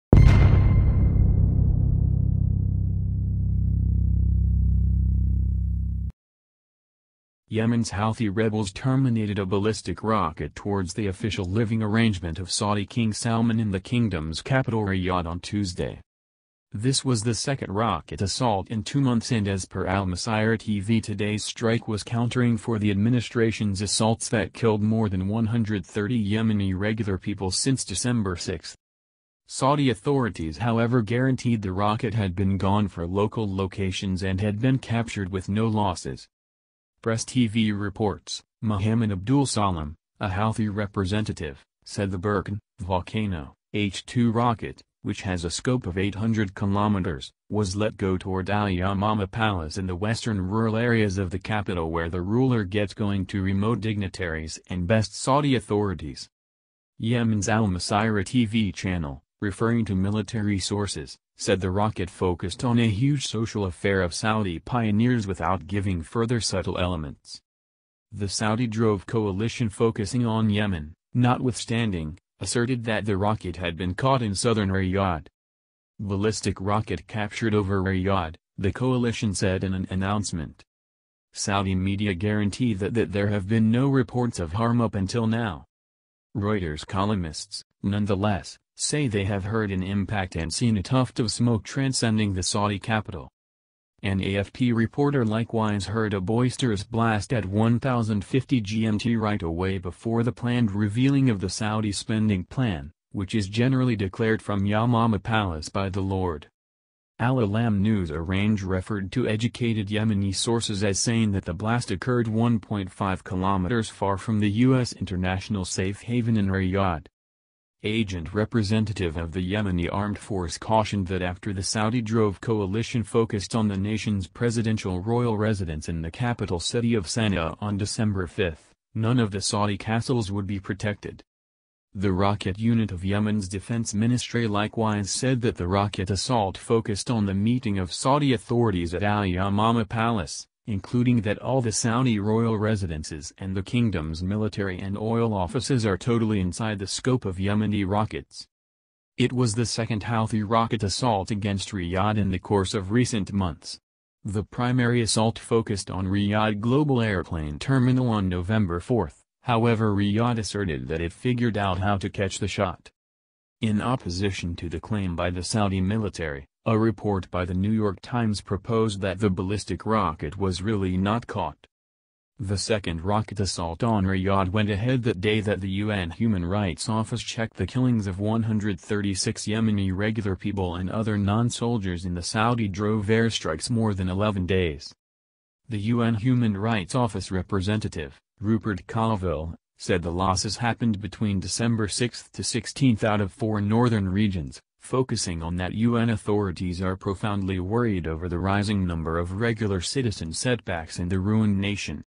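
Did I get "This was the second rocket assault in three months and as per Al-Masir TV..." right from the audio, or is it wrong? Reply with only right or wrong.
wrong.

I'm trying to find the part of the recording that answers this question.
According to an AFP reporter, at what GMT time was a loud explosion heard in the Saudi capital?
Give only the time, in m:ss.
1:37.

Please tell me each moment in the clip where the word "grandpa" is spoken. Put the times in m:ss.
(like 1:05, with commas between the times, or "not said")
not said.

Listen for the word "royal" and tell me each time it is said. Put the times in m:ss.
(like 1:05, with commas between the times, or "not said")
2:04, 2:22.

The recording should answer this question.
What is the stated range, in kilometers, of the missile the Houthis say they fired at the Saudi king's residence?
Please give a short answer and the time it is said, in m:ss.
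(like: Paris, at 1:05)
800 kilometers, at 0:45.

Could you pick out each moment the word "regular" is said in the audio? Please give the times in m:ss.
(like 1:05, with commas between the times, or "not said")
0:26, 2:59, 3:19.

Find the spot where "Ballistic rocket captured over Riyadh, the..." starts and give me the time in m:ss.
1:15.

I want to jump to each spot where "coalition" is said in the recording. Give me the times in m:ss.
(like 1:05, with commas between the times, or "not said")
1:09, 1:18, 2:02.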